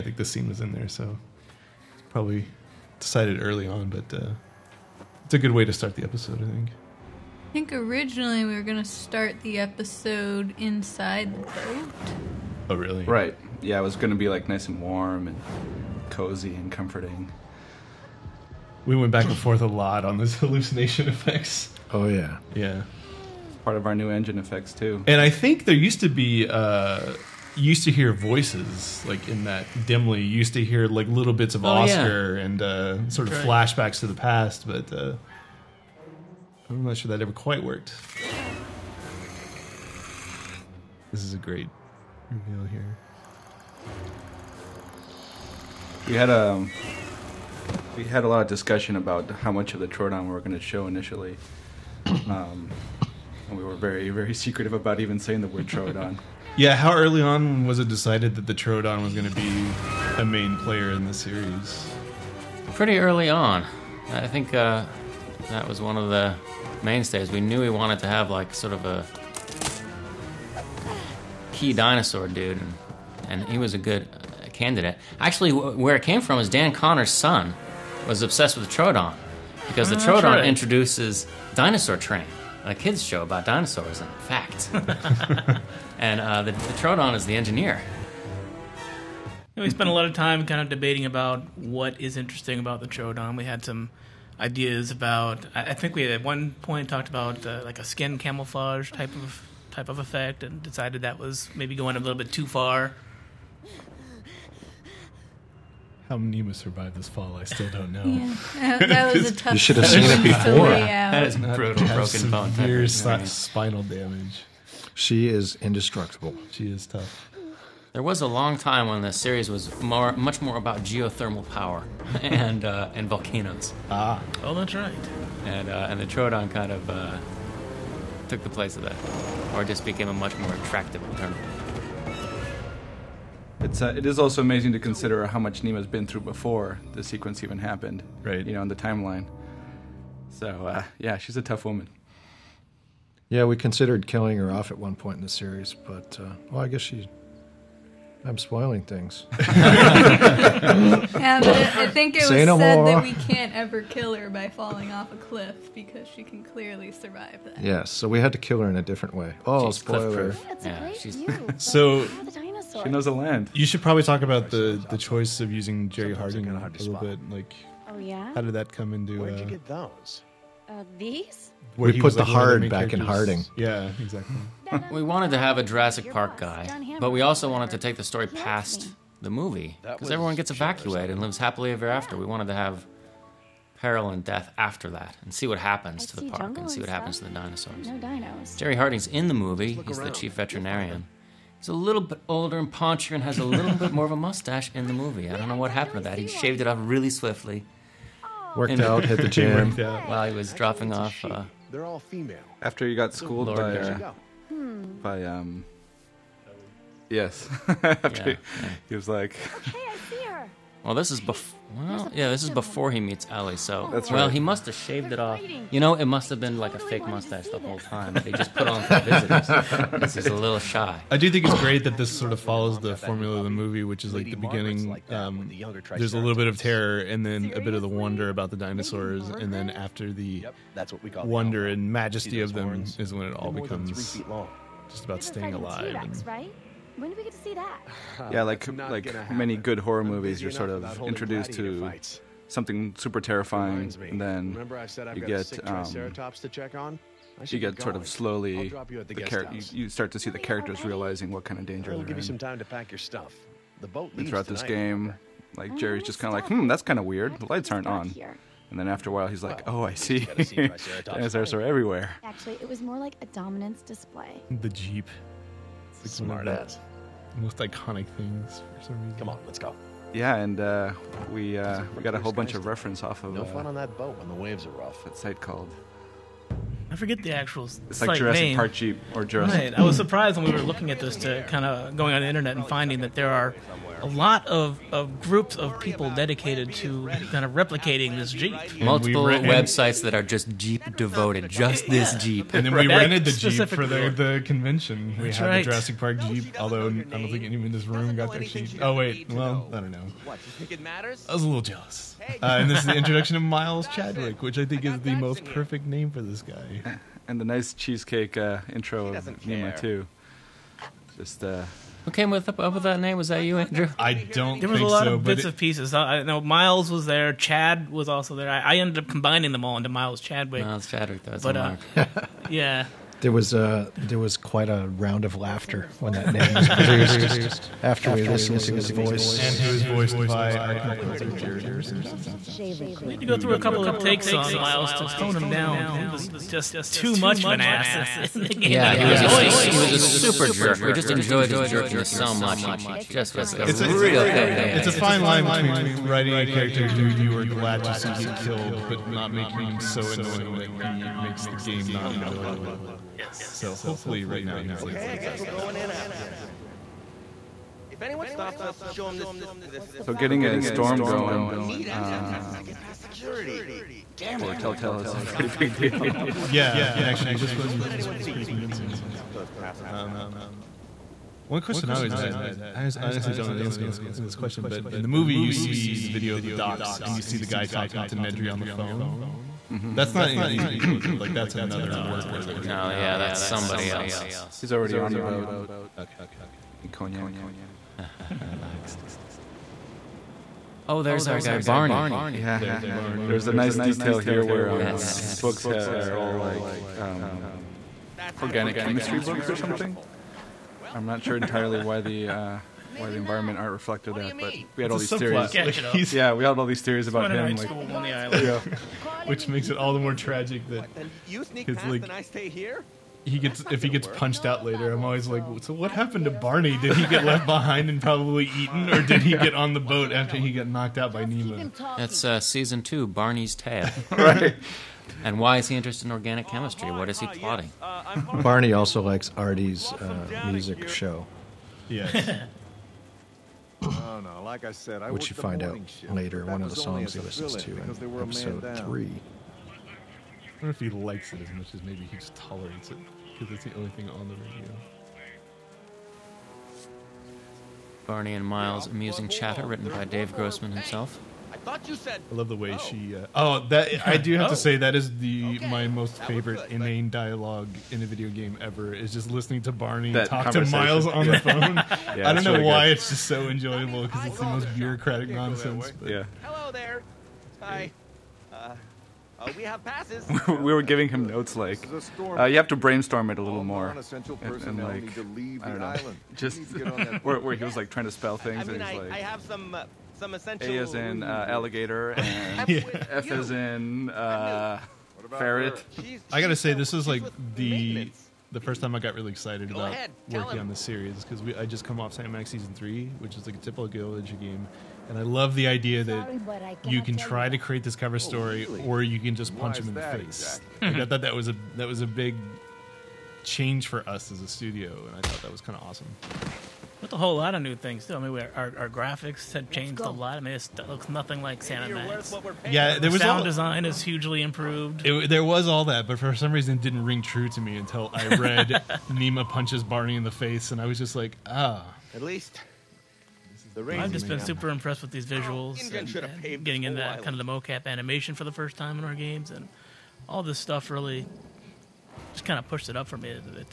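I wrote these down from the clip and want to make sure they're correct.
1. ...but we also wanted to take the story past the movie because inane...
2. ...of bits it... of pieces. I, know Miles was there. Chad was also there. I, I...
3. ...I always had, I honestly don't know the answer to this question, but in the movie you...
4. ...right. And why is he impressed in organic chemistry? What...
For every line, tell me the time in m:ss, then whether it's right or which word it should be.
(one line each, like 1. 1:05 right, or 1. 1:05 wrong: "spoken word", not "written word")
1. 2:56 wrong: "everyone", not "inane"
2. 5:15 right
3. 6:11 right
4. 7:04 wrong: "interested", not "impressed".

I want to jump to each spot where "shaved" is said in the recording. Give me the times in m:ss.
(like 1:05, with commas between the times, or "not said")
3:16, 3:34.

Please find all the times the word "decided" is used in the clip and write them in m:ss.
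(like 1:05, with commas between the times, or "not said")
0:02, 0:57, 1:40.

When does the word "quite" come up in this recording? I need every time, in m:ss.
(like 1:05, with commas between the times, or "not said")
0:37, 5:24.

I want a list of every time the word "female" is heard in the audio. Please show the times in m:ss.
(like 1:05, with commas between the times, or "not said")
3:21.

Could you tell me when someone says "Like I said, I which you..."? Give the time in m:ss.
7:14.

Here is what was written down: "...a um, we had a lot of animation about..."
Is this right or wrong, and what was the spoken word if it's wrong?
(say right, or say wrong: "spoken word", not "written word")
wrong: "discussion", not "animation".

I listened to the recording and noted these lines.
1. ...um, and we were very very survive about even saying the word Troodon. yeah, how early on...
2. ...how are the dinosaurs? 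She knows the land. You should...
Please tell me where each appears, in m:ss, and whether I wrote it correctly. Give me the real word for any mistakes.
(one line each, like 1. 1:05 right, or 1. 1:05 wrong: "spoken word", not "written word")
1. 0:52 wrong: "secretive", not "survive"
2. 2:42 right.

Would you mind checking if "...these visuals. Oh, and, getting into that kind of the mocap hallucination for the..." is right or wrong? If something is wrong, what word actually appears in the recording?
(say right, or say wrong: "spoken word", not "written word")
wrong: "animation", not "hallucination".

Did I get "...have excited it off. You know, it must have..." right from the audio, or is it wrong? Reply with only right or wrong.
wrong.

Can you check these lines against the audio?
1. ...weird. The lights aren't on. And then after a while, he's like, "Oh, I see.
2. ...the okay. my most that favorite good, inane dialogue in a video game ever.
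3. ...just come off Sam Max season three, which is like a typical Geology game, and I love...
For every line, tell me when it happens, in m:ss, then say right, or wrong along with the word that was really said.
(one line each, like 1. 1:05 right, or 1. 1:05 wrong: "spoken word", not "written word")
1. 4:17 right
2. 7:35 right
3. 8:11 right.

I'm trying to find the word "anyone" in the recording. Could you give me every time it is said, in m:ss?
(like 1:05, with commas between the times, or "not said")
4:57, 5:58.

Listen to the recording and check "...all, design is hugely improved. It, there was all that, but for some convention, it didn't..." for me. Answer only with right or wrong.
wrong.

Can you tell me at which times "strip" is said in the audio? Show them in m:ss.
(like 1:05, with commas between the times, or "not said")
not said.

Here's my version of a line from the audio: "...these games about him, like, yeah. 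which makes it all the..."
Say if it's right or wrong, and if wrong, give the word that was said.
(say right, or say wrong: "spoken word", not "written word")
wrong: "theories", not "games".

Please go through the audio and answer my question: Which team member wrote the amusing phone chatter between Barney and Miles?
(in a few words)
Dave Grossman.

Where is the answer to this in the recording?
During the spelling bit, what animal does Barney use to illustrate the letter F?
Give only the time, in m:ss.
8:05.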